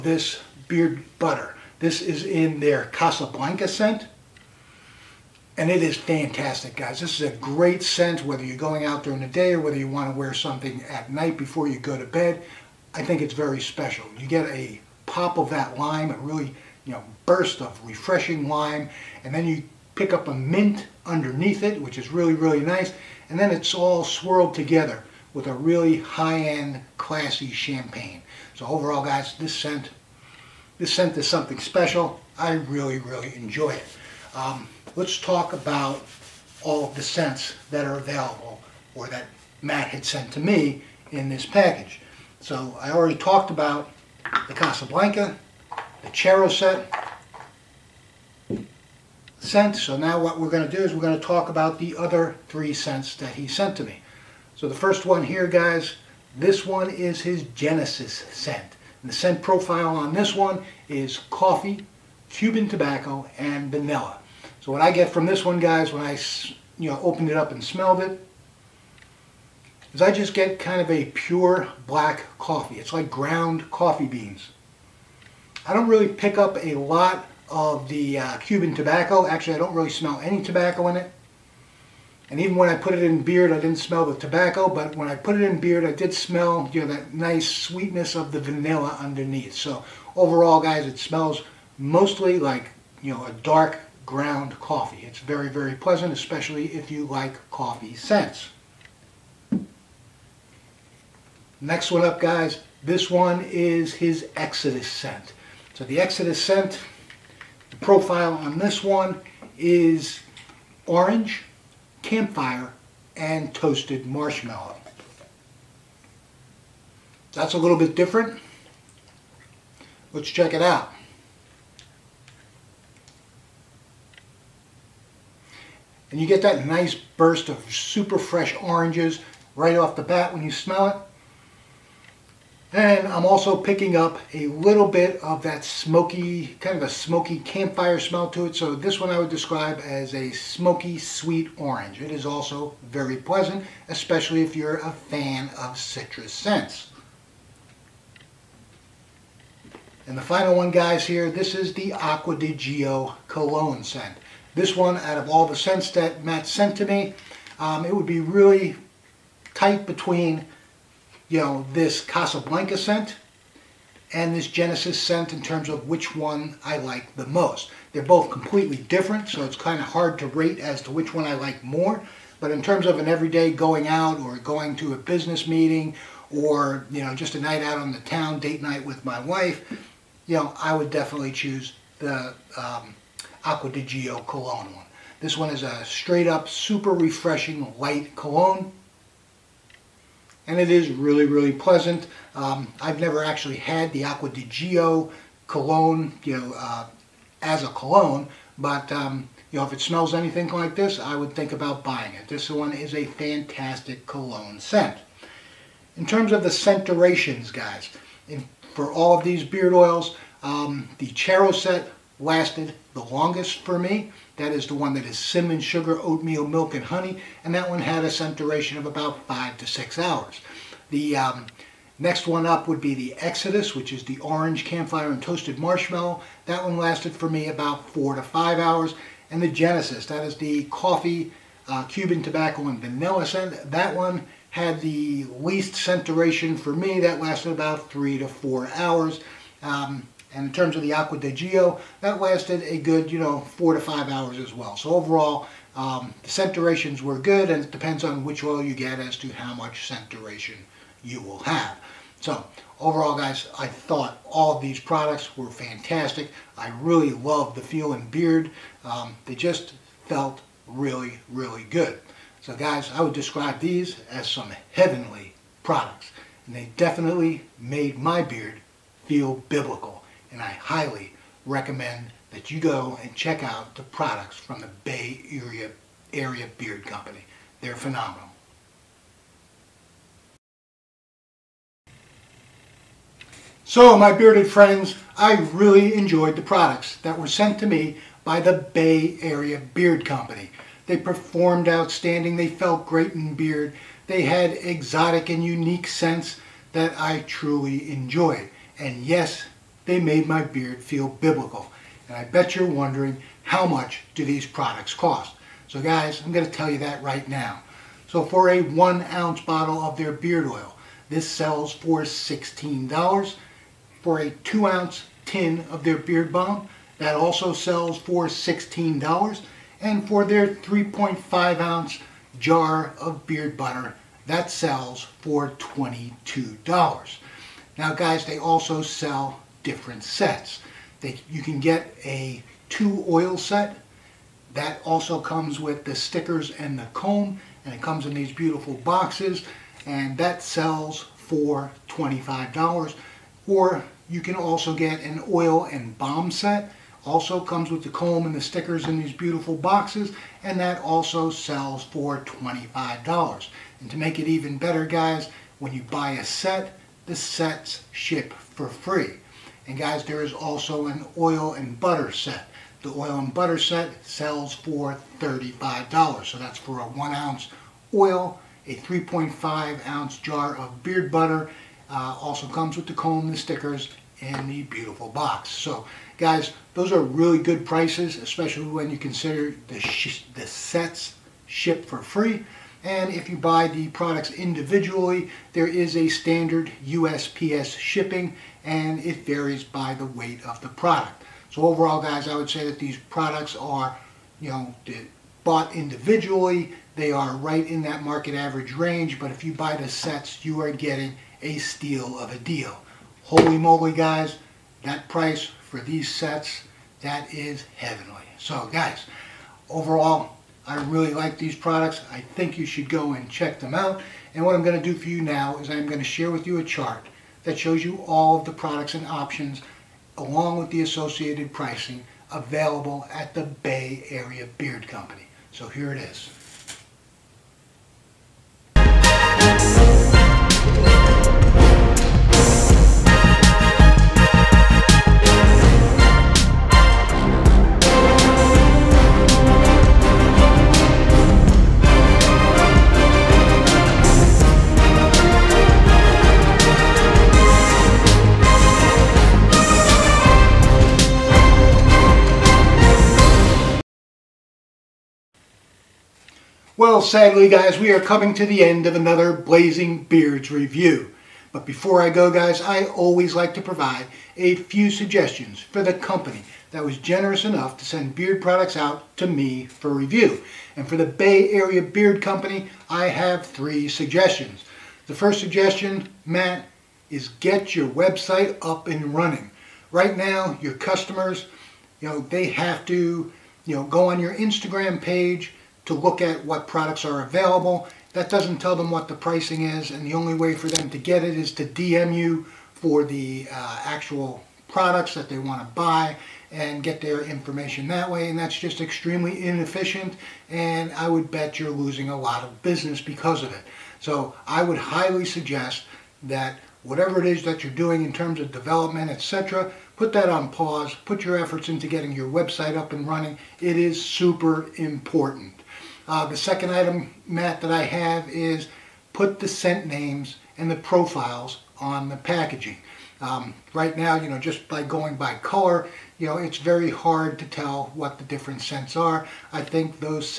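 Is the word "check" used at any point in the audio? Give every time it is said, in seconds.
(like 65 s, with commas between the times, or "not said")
120 s, 273 s, 413 s.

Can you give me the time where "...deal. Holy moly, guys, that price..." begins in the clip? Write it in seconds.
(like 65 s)
402 s.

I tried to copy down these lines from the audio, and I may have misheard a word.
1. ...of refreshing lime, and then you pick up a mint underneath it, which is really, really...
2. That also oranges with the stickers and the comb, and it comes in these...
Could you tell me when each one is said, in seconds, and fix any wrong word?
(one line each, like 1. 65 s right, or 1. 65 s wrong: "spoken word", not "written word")
1. 17 s right
2. 334 s wrong: "comes", not "oranges".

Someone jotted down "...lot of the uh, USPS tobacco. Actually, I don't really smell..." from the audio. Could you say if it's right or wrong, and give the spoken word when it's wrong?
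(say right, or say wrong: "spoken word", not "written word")
wrong: "Cuban", not "USPS".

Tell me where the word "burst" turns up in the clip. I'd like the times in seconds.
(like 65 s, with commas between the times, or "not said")
17 s, 126 s.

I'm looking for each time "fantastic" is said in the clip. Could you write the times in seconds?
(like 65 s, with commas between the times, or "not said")
5 s, 203 s, 255 s.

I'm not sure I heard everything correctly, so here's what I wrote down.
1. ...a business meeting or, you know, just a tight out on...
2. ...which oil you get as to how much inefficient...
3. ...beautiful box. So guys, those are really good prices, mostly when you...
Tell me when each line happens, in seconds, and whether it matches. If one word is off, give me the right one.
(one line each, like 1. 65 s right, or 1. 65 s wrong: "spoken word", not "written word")
1. 174 s wrong: "night", not "tight"
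2. 248 s wrong: "scent", not "inefficient"
3. 374 s wrong: "especially", not "mostly".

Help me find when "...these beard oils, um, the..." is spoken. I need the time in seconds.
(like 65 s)
209 s.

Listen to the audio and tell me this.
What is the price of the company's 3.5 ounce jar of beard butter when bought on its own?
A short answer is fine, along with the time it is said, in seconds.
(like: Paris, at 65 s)
$22, at 325 s.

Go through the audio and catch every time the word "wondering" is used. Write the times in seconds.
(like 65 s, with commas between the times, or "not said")
302 s.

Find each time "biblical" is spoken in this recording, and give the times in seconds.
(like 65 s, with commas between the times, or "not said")
269 s, 301 s.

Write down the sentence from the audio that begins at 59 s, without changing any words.
And the scent profile on this one is coffee, Cuban tobacco, and vanilla.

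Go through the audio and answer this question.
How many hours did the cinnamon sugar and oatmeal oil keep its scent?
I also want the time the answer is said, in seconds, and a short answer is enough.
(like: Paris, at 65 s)
5 to 6 hours, at 219 s.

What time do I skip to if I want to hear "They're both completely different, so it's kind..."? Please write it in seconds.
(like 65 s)
167 s.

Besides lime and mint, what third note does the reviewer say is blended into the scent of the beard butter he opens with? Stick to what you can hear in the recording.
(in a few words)
champagne.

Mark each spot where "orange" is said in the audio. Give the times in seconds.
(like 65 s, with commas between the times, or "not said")
110 s, 128 s, 141 s, 224 s.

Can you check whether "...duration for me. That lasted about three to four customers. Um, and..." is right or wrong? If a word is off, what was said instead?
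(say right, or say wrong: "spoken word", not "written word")
wrong: "hours", not "customers".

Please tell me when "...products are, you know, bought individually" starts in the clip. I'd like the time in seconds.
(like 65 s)
393 s.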